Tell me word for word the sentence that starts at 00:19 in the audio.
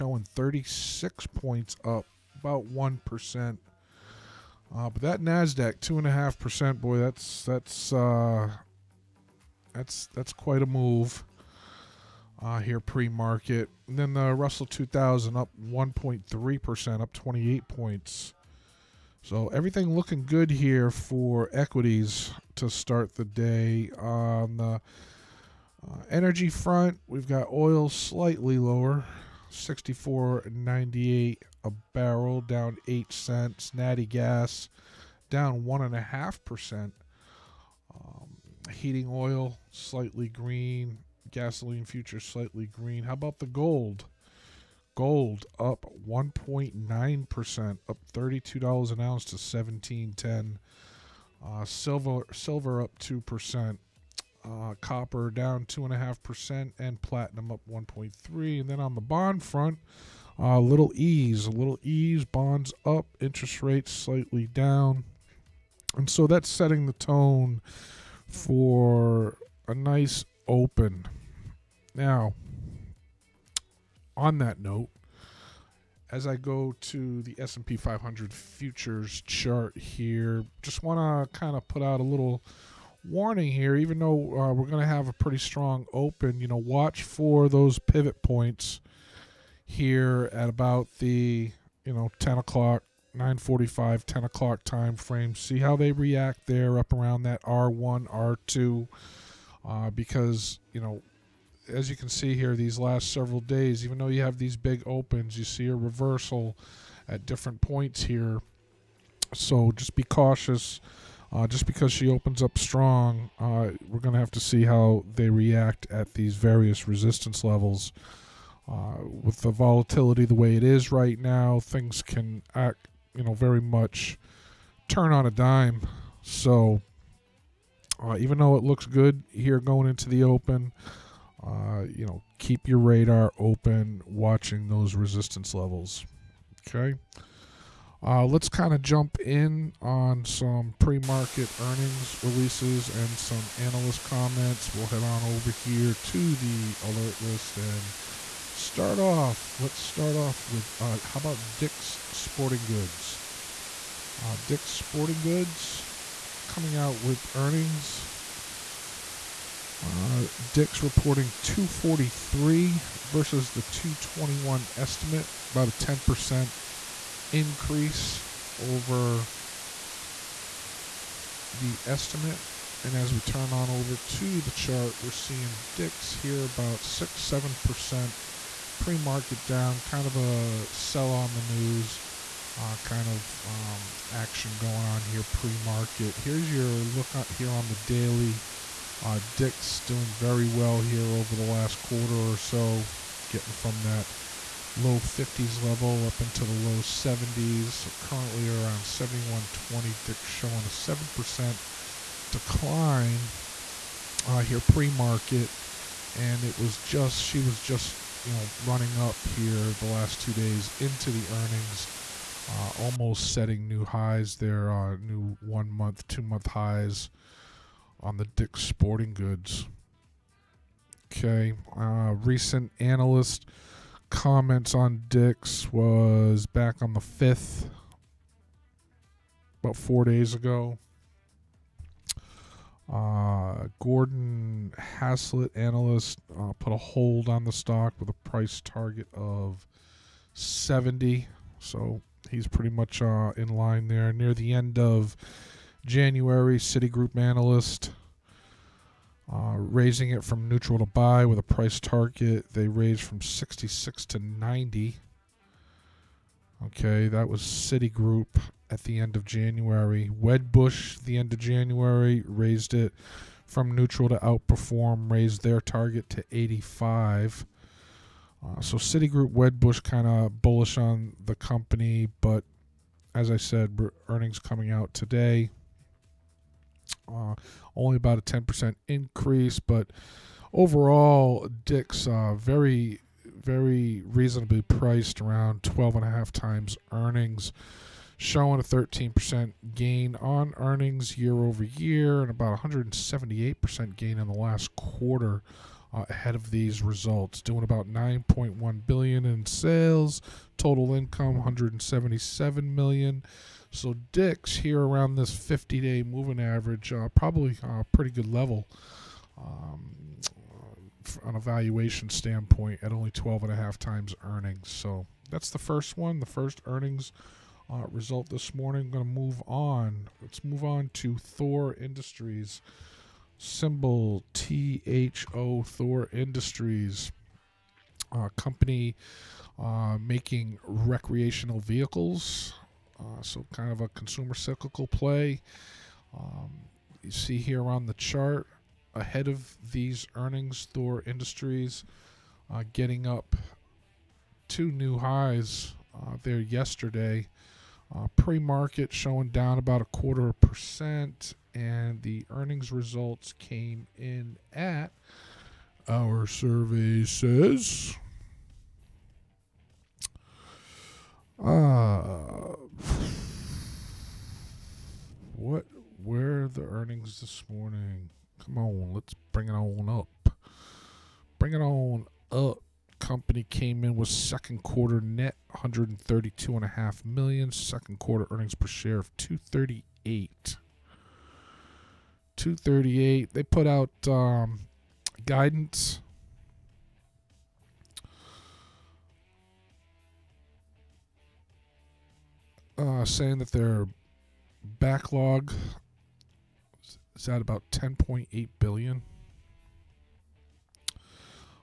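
So everything looking good here for equities to start the day on the uh, energy front.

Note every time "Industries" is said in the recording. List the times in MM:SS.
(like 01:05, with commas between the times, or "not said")
05:21, 05:26, 05:41.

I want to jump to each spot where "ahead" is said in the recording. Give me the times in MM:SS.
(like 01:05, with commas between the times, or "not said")
04:56, 05:38.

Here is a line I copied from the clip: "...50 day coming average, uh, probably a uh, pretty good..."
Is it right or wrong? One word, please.
wrong.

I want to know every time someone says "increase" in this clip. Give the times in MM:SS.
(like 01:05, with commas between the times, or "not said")
02:47, 04:38.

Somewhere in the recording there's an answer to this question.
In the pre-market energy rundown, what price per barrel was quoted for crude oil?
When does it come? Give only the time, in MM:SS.
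00:29.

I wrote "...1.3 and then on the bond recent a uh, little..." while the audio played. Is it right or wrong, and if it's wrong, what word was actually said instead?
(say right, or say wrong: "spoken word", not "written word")
wrong: "front", not "recent".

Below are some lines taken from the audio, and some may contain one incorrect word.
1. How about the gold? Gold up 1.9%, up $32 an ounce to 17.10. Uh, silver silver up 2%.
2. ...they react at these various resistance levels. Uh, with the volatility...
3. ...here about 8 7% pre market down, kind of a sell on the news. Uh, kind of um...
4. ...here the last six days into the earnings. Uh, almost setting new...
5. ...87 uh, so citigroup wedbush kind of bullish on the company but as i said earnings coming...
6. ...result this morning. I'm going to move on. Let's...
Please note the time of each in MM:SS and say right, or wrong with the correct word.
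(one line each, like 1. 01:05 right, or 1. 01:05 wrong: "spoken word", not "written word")
1. 00:43 right
2. 01:55 right
3. 02:56 wrong: "6", not "8"
4. 03:29 wrong: "two", not "six"
5. 04:26 wrong: "85", not "87"
6. 05:17 right.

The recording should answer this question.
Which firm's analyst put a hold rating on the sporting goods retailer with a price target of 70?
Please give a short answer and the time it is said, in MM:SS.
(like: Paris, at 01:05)
Gordon Haskett, at 03:53.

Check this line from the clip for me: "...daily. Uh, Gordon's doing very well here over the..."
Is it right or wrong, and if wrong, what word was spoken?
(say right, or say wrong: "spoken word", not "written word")
wrong: "Dick", not "Gordon".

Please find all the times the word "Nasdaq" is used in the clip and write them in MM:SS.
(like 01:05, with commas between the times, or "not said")
00:05.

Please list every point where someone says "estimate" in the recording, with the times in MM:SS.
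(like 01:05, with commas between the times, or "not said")
02:44, 02:51.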